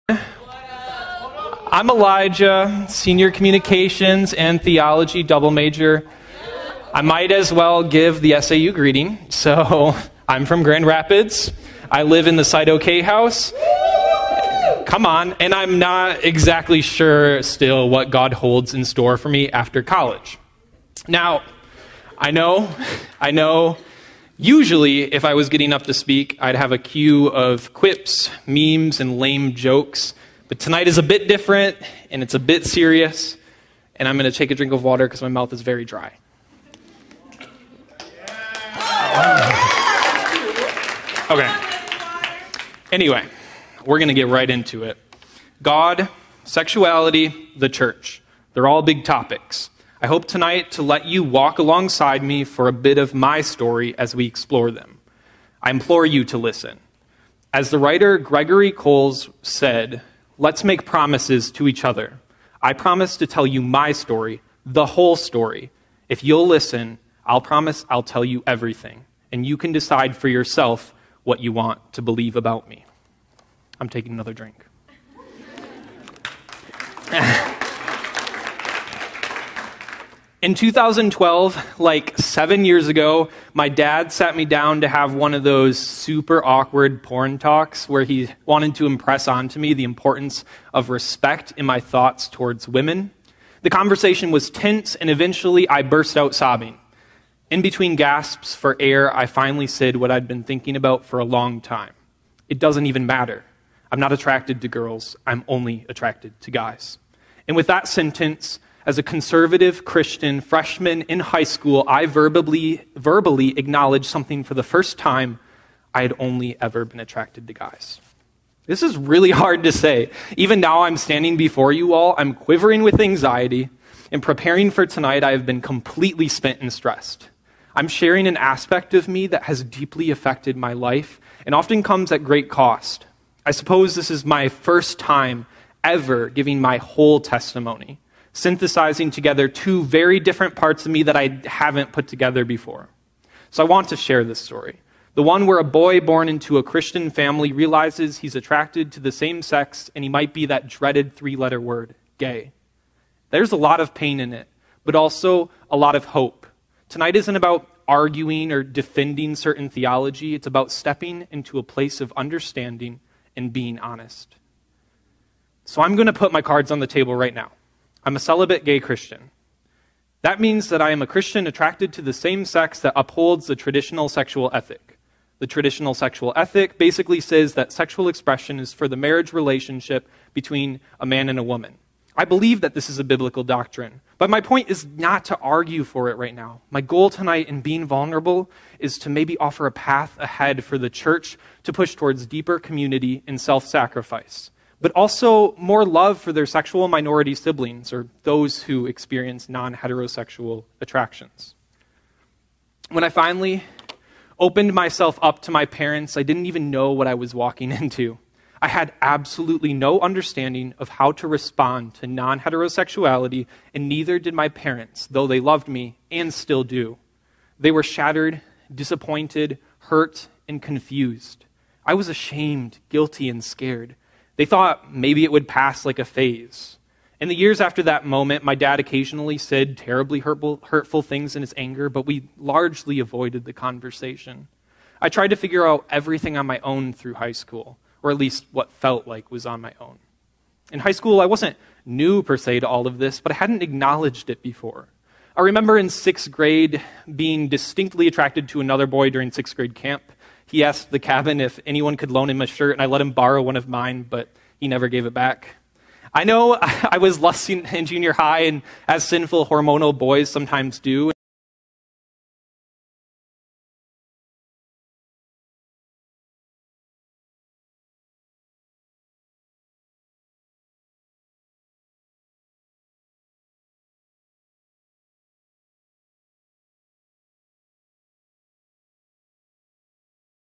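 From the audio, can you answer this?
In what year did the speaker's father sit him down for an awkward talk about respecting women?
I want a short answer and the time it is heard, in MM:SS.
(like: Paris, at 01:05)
2012, at 01:20.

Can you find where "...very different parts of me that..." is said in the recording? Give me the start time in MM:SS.
02:19.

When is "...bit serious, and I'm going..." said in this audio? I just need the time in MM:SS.
00:32.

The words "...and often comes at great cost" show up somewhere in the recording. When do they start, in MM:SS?
02:11.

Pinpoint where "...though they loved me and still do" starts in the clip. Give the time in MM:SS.
03:35.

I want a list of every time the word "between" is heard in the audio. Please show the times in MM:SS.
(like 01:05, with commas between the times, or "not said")
01:37, 03:00.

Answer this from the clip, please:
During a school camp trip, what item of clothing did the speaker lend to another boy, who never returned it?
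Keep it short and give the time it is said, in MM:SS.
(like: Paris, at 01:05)
shirt, at 04:12.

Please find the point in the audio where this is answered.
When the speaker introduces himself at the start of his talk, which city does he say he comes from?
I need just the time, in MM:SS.
00:10.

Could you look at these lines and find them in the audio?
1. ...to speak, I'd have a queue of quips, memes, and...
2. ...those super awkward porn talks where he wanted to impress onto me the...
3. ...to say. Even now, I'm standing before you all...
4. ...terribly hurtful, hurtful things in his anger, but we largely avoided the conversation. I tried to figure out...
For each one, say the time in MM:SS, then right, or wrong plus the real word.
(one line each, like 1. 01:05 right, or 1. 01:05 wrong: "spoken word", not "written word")
1. 00:25 right
2. 01:25 right
3. 01:59 right
4. 03:49 right.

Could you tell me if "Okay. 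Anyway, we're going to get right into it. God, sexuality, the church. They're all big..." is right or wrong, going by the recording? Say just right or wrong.
right.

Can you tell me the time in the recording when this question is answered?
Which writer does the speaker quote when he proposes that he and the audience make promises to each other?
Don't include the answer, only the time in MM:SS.
00:58.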